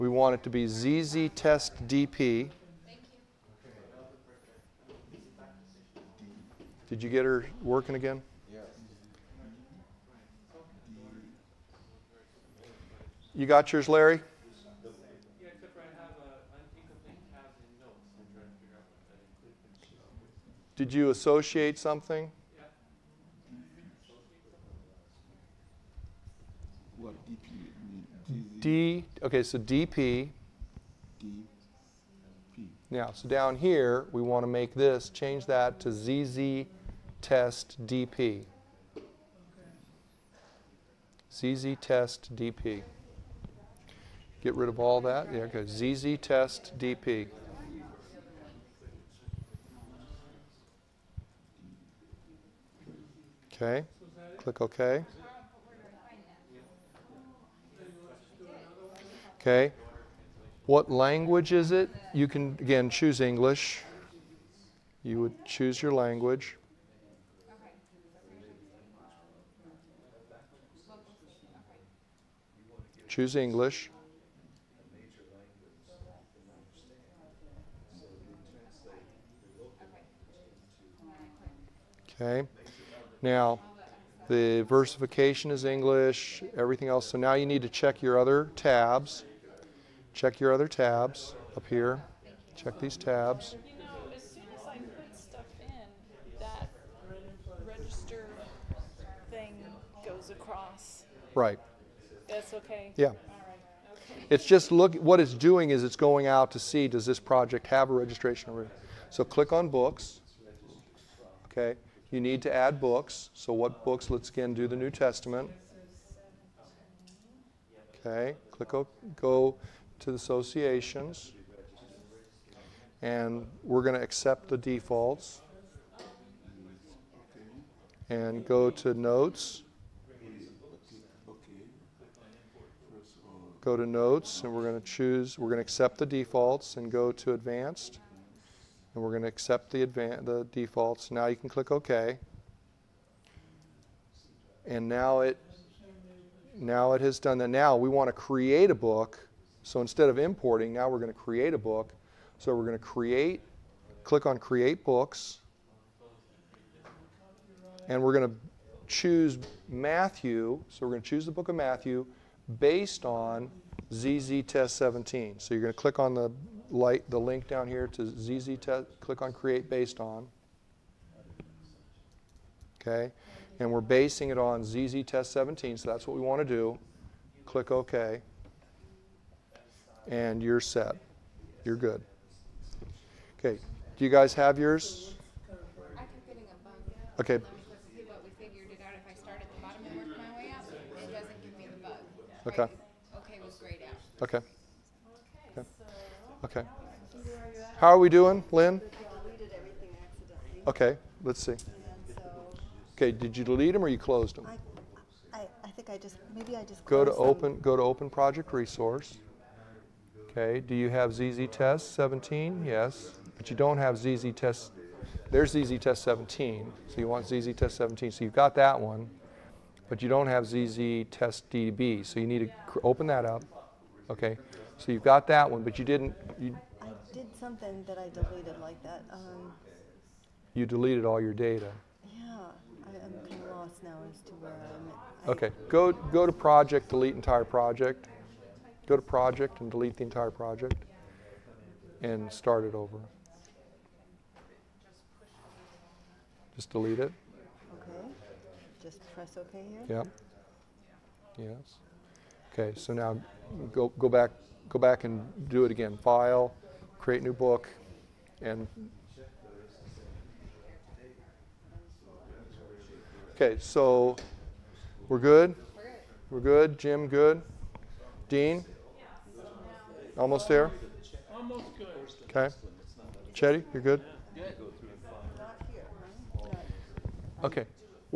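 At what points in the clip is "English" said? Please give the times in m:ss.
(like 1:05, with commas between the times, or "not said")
1:03, 1:13, 1:25.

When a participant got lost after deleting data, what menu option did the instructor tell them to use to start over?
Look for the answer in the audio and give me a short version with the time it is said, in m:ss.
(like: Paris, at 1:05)
Delete entire project, at 3:56.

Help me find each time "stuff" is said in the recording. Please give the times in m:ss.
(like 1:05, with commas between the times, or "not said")
1:35.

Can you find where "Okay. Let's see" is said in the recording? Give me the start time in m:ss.
3:20.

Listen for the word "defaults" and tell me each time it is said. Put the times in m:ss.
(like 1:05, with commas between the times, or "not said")
2:04, 2:16, 2:20.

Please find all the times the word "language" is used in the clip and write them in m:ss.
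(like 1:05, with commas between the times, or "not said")
1:00, 1:05.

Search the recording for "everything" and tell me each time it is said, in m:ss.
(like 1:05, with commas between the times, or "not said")
1:26.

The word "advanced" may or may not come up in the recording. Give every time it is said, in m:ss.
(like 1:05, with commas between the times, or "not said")
2:17.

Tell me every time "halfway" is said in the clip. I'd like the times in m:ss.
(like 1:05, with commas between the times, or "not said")
not said.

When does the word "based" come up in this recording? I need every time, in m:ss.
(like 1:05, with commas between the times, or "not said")
2:42, 2:49.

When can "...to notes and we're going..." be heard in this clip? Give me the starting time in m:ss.
2:13.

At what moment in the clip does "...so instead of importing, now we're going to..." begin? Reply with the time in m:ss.
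2:29.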